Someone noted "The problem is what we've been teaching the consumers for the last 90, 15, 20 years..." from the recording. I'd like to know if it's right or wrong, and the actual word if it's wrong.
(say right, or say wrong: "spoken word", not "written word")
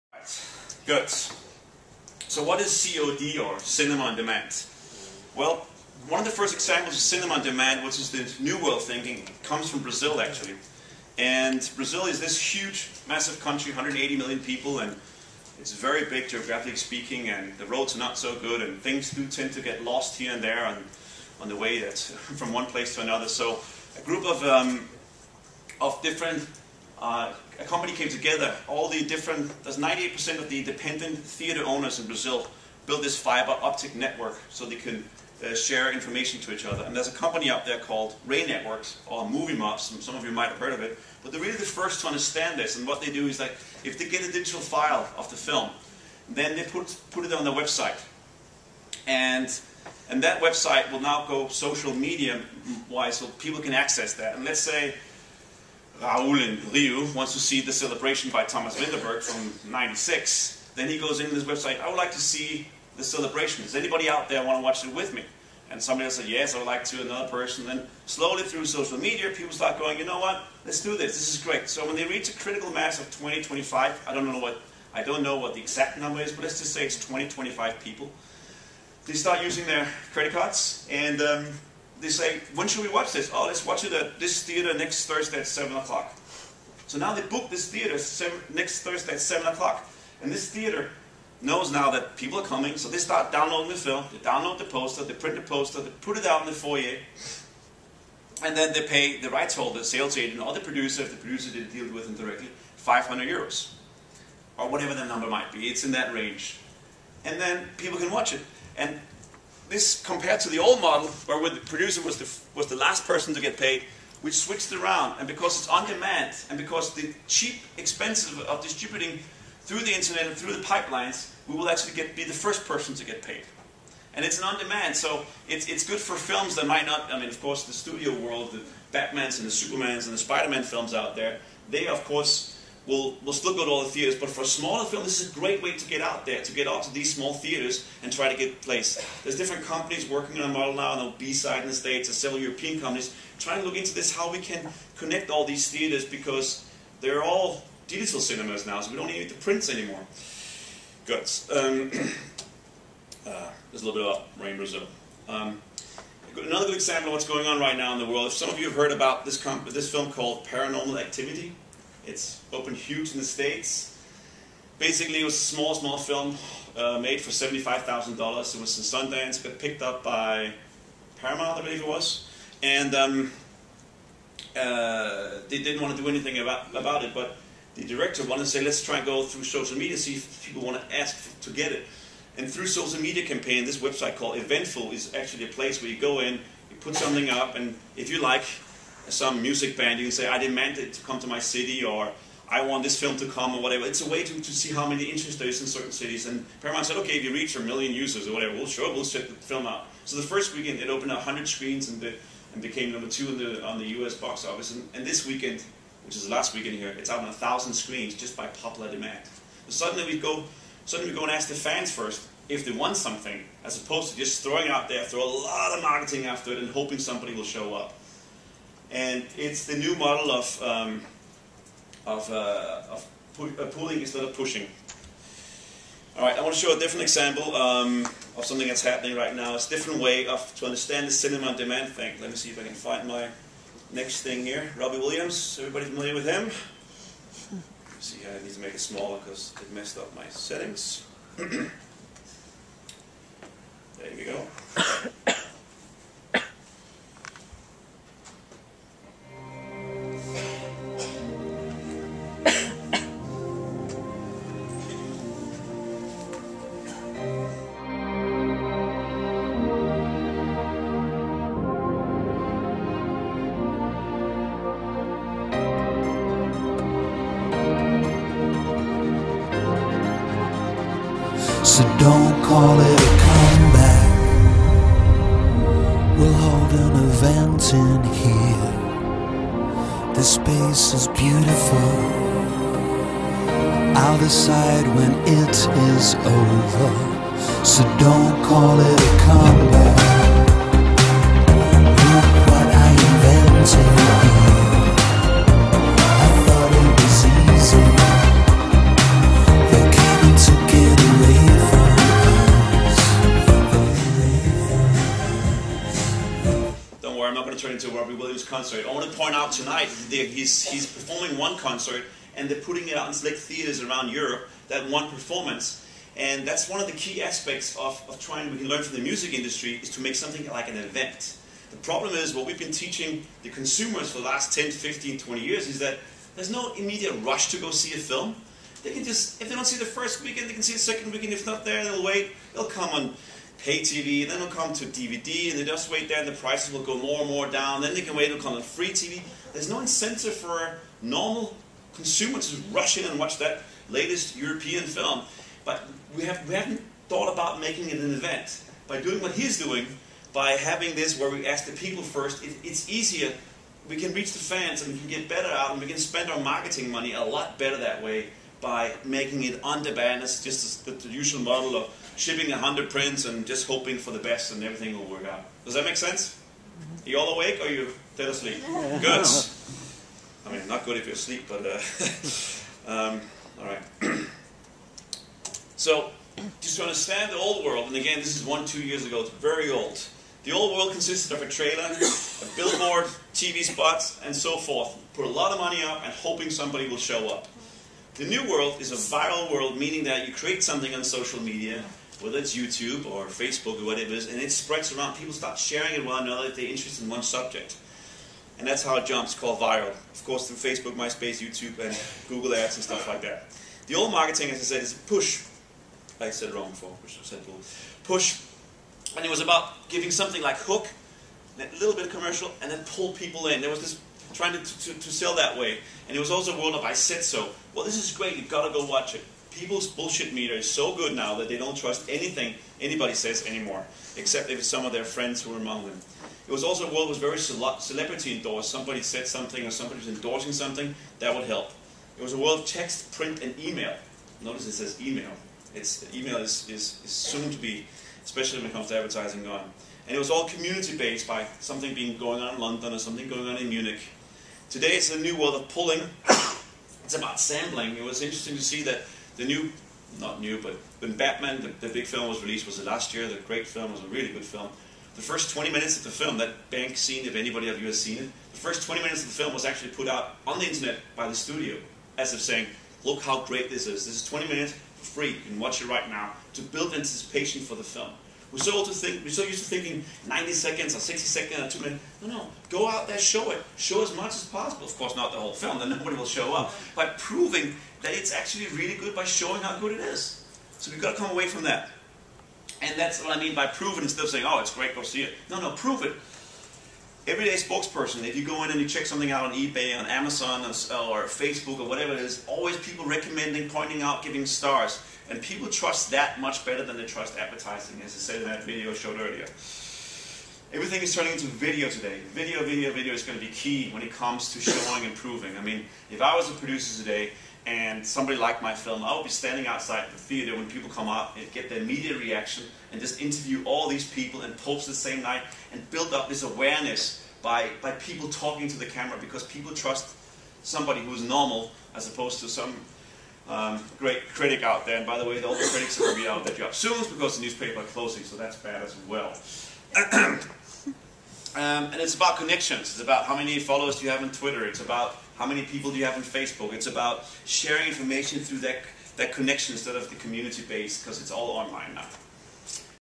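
wrong: "10", not "90".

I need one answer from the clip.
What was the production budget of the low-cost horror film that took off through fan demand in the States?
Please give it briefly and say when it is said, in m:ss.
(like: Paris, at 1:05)
$75,000, at 2:47.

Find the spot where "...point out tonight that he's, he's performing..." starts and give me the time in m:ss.
5:09.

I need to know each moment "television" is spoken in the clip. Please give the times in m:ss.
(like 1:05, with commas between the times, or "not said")
not said.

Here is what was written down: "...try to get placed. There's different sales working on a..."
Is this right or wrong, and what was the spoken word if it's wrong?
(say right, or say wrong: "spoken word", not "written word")
wrong: "companies", not "sales".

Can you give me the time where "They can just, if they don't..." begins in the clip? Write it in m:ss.
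5:28.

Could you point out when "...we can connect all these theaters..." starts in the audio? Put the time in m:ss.
2:24.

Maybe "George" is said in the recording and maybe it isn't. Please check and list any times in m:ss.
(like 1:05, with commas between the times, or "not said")
not said.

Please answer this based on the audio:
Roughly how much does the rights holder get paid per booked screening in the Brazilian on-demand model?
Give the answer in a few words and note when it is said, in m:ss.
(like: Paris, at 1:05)
500 euros, at 1:42.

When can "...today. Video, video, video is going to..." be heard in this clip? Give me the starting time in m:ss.
8:21.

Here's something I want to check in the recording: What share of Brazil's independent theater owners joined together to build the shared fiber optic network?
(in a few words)
98%.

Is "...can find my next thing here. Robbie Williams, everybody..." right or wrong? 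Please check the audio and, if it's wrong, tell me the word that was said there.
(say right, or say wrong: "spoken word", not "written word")
right.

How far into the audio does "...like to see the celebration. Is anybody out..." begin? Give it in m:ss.
1:01.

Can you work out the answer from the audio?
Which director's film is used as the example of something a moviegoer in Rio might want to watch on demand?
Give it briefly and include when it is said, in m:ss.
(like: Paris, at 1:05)
Thomas Vinterberg, at 0:58.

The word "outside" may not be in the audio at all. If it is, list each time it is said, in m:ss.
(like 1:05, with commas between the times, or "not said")
8:29.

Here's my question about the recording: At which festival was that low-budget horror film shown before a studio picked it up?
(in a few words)
Sundance.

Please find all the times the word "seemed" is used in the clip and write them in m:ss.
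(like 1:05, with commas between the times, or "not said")
not said.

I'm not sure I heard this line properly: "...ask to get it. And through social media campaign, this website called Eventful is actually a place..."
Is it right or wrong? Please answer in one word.
right.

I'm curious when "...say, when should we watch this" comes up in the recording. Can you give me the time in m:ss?
1:22.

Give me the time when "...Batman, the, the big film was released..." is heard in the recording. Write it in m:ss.
7:31.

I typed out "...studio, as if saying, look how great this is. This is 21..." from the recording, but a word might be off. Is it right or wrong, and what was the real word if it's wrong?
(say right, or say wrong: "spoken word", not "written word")
wrong: "20", not "21".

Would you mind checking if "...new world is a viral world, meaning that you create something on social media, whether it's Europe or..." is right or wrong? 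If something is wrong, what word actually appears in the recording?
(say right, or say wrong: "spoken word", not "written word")
wrong: "YouTube", not "Europe".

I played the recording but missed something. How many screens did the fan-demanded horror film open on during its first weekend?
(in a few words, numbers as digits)
100.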